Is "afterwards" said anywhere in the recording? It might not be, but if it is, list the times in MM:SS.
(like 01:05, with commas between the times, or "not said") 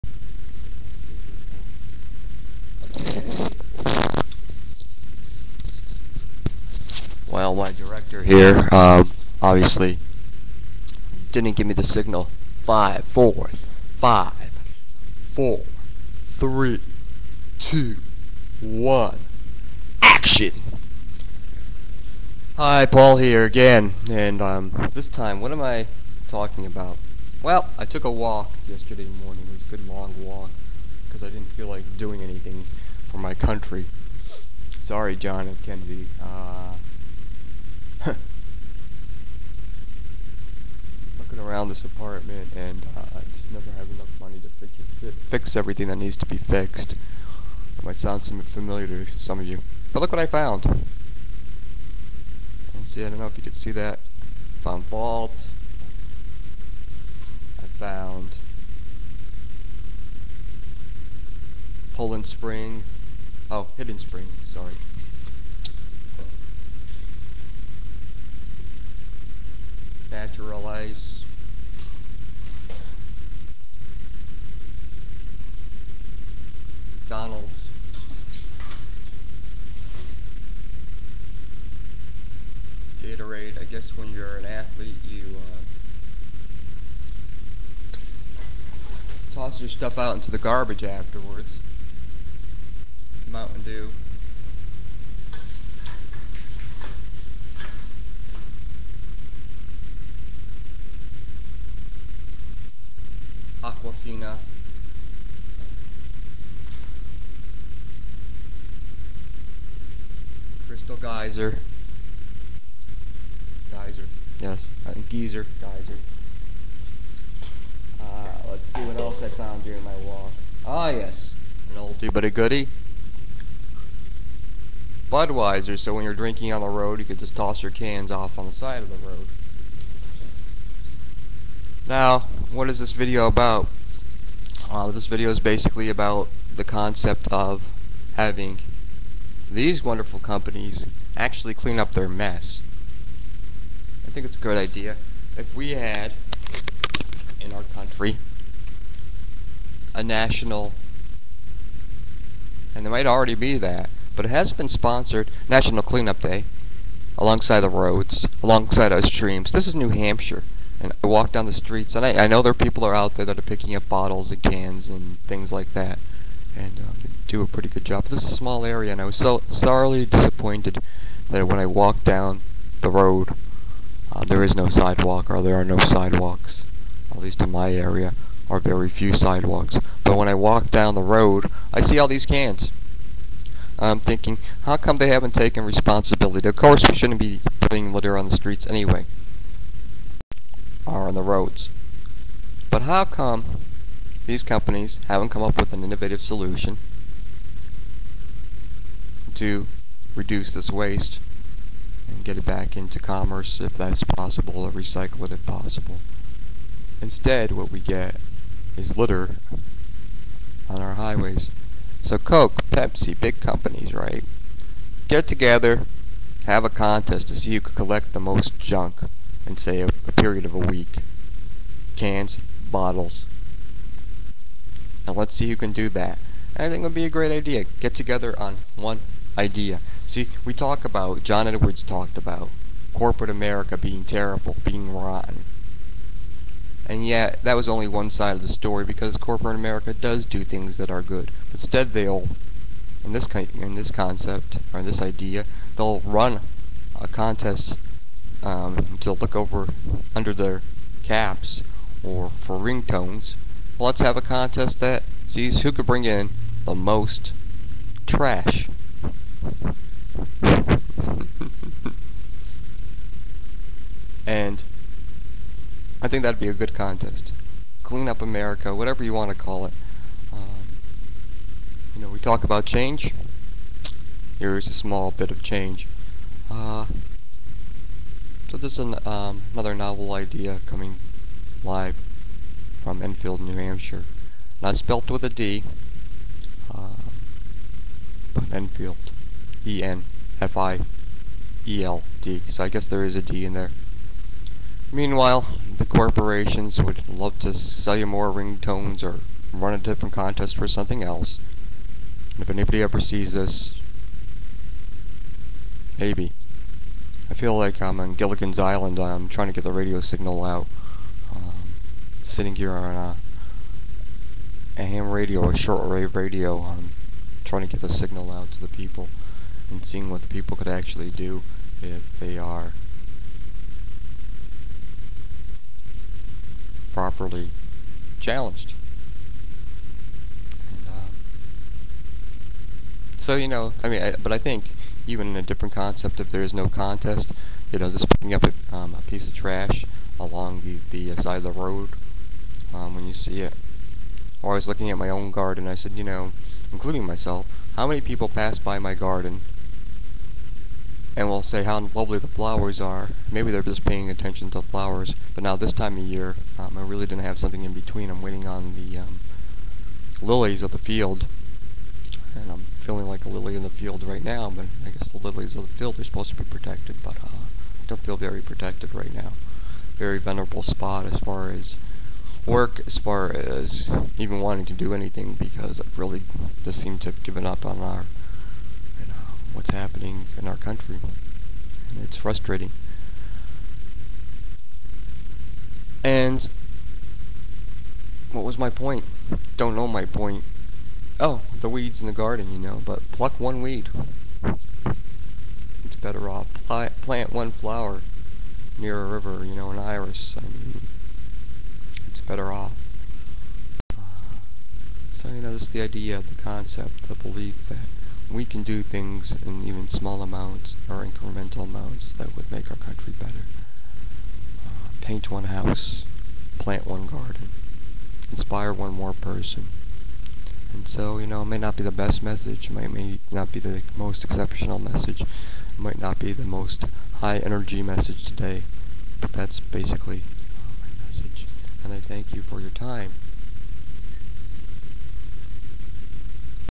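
01:30.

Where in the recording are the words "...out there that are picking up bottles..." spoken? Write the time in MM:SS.
02:42.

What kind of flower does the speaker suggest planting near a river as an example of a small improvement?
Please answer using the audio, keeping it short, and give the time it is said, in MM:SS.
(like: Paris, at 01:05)
An iris, at 06:39.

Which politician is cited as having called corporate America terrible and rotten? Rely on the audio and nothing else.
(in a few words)
John Edwards.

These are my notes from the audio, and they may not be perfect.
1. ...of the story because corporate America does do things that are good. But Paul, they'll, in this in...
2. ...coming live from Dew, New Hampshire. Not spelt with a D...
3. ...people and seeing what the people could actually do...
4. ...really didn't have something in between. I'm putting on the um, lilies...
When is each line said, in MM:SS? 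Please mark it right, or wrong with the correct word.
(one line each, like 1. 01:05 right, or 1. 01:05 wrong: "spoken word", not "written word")
1. 03:58 wrong: "Instead", not "Paul"
2. 04:40 wrong: "Enfield", not "Dew"
3. 05:18 right
4. 05:56 wrong: "waiting", not "putting".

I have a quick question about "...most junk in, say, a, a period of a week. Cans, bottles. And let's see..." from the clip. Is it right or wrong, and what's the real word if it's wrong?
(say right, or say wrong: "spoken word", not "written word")
right.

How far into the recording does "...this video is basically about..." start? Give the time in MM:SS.
02:14.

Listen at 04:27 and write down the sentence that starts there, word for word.
Clean up America, whatever you want to call it.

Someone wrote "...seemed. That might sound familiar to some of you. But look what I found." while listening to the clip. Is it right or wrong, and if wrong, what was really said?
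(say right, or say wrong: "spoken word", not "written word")
wrong: "fixed", not "seemed".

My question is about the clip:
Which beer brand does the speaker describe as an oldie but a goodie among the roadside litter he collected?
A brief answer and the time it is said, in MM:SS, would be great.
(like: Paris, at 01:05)
Budweiser, at 02:05.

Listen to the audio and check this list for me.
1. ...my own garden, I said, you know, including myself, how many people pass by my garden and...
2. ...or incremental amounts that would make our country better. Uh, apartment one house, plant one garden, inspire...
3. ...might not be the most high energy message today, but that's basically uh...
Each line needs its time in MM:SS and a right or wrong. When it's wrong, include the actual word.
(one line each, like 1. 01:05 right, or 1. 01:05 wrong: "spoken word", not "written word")
1. 05:44 right
2. 06:50 wrong: "paint", not "apartment"
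3. 07:05 right.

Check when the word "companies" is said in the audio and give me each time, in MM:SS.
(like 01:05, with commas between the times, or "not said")
02:20, 03:14, 03:33.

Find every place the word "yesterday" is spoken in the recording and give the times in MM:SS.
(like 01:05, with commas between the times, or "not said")
00:28.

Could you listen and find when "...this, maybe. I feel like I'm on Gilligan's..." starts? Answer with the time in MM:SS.
05:03.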